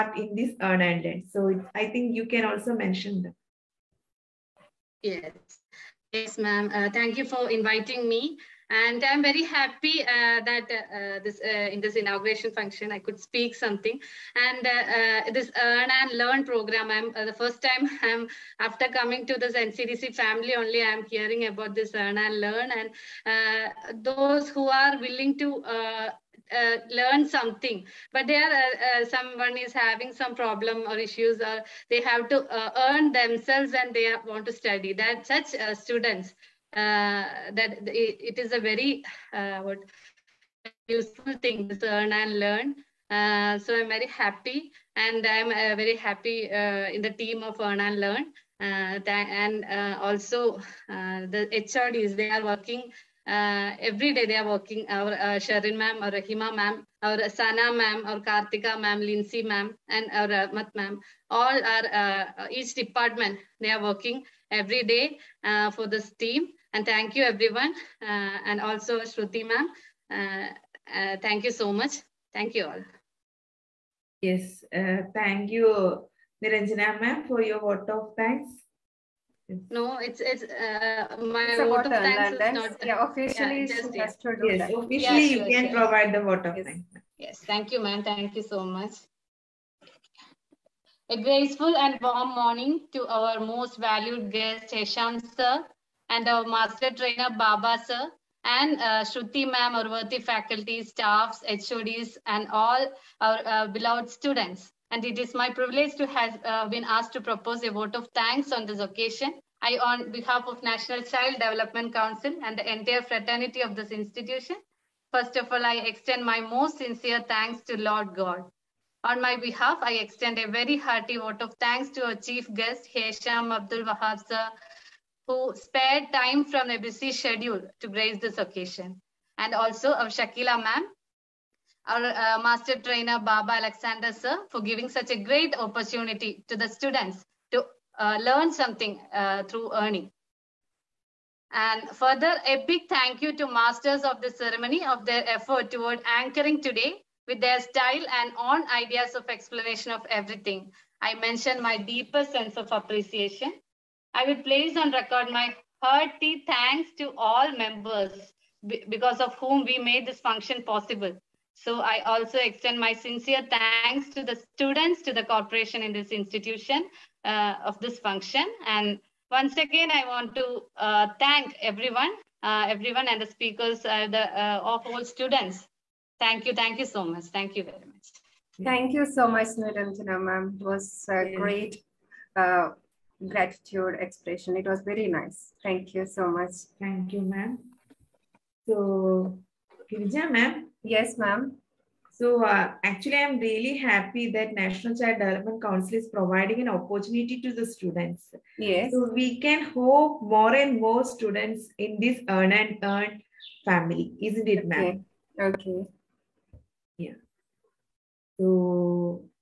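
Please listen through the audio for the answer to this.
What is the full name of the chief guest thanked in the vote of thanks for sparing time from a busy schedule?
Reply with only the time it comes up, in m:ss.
2:02.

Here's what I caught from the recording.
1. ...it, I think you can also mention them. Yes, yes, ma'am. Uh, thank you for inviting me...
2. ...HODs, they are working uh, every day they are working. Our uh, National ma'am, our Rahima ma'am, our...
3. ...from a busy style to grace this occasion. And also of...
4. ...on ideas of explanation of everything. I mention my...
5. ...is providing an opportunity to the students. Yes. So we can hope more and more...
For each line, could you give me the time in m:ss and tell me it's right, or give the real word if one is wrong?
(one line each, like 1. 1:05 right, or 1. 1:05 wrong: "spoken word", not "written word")
1. 0:01 right
2. 0:51 wrong: "Sherin", not "National"
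3. 2:06 wrong: "schedule", not "style"
4. 2:28 right
5. 3:15 right.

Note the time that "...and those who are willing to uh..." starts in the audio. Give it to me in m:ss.
0:22.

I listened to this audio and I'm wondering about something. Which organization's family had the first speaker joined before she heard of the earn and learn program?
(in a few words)
NCDC.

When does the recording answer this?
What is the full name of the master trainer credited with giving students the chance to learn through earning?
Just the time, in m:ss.
2:13.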